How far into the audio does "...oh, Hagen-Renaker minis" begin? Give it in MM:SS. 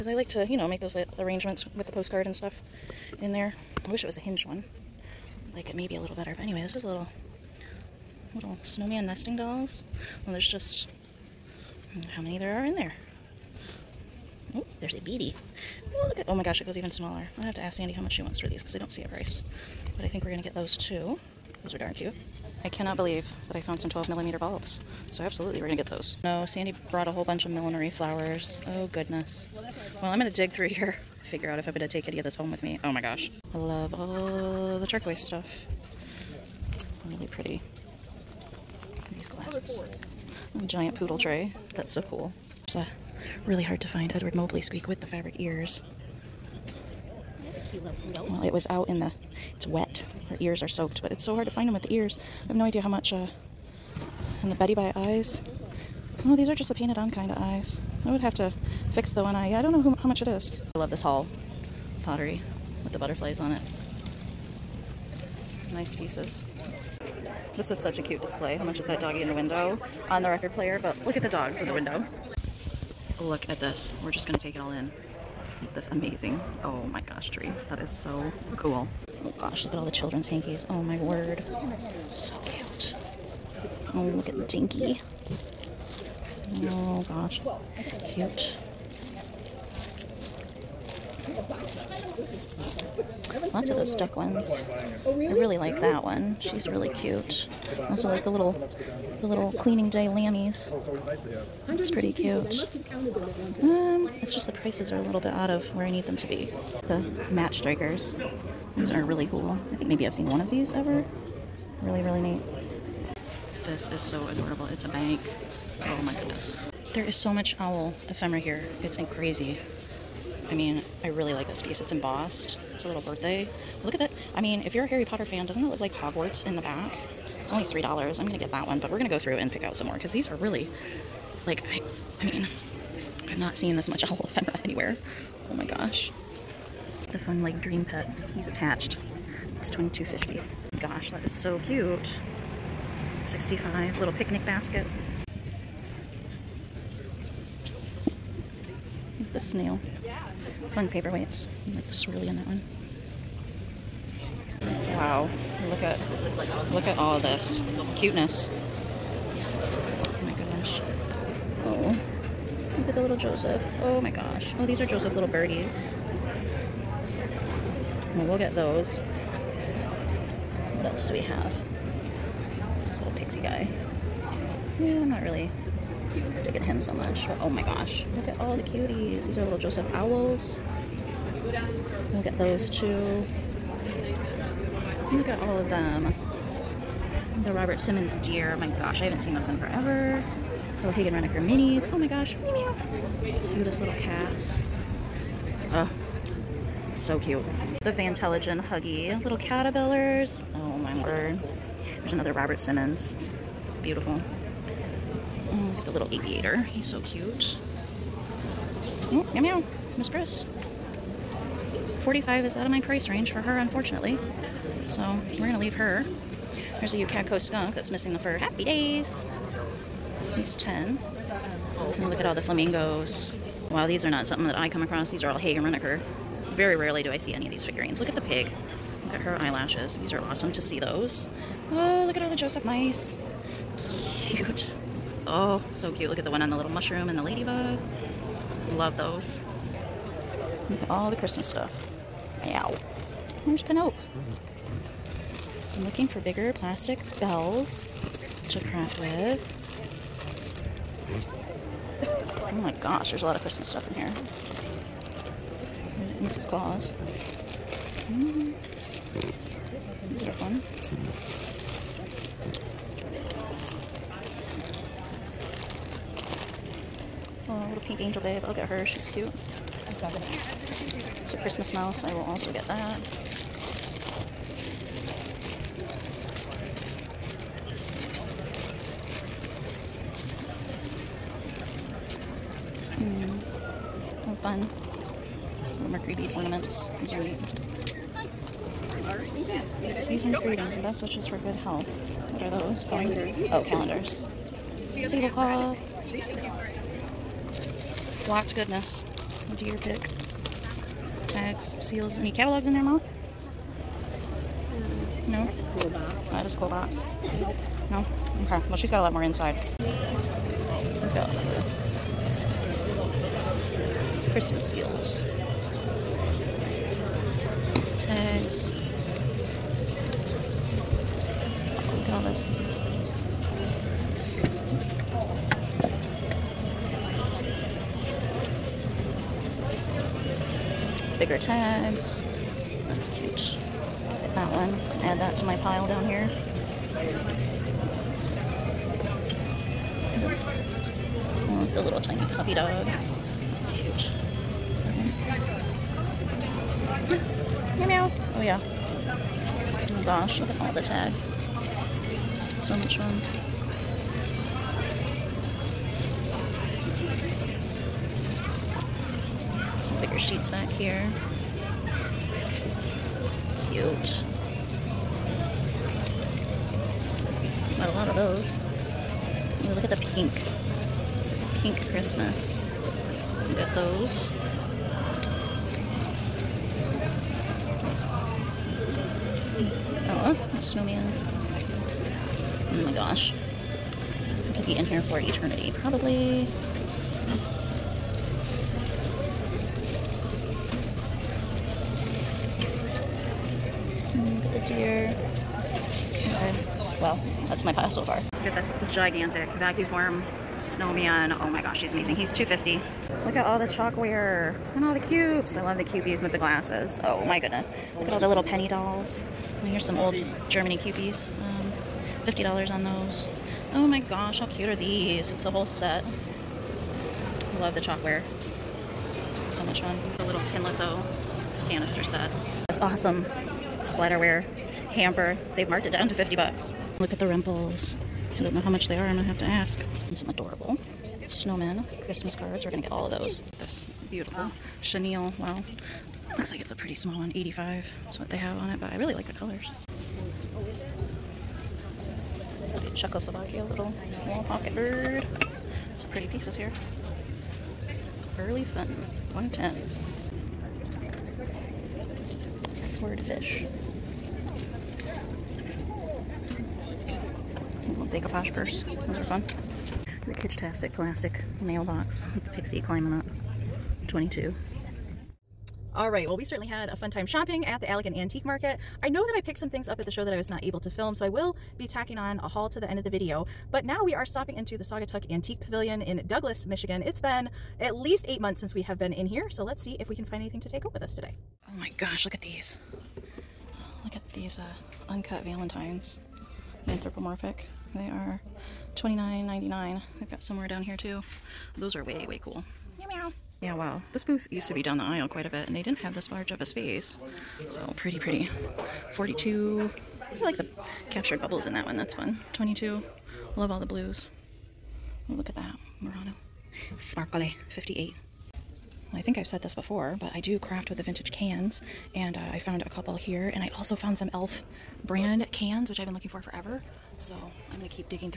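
03:10.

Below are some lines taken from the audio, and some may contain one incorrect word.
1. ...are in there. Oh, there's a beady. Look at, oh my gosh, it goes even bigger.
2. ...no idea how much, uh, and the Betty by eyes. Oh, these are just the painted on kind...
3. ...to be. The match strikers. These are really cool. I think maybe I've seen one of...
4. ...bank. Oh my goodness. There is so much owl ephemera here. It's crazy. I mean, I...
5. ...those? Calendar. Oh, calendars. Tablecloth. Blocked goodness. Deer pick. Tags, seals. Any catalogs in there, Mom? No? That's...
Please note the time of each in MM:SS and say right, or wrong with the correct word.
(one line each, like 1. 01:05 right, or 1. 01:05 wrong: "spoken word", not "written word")
1. 00:12 wrong: "smaller", not "bigger"
2. 00:52 right
3. 01:46 right
4. 01:54 right
5. 04:52 right.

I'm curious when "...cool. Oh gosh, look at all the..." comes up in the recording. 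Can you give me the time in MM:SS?
01:18.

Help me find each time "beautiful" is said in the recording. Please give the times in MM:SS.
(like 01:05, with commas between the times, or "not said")
03:23, 07:14.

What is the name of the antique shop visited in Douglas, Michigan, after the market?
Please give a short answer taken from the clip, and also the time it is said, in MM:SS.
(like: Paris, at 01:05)
Saugatuck Antique Pavilion, at 07:54.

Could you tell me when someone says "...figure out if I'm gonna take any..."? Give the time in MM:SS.
00:31.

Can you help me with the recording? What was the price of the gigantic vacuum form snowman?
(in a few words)
250.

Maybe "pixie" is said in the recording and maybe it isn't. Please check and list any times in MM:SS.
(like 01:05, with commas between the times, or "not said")
02:53, 07:42.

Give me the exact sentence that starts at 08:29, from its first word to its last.
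I think I've said this before, but I do craft with the vintage cans.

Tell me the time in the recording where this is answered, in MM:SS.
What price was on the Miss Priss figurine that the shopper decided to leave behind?
03:32.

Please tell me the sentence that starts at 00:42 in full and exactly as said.
It's a uh, really hard to find Edward Mobley squeak with the fabric ears.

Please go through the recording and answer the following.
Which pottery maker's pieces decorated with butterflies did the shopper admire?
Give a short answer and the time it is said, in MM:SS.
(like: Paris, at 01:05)
Hall, at 01:01.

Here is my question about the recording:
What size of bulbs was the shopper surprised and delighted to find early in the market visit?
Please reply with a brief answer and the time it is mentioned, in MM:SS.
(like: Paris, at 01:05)
12 millimeter, at 00:23.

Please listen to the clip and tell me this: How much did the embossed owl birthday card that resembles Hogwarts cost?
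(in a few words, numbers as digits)
$3.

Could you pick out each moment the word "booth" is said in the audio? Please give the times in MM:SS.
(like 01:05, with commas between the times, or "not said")
08:14.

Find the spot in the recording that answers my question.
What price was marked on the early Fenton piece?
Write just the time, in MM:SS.
07:29.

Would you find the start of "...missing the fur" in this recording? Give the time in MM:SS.
03:37.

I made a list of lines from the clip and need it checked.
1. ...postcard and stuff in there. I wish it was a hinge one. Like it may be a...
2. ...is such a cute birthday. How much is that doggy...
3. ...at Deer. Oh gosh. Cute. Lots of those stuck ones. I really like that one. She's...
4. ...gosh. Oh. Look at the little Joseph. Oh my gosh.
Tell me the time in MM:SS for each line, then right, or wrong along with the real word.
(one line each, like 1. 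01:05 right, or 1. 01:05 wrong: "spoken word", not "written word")
1. 00:01 right
2. 01:07 wrong: "display", not "birthday"
3. 01:24 wrong: "Dinky", not "Deer"
4. 02:40 right.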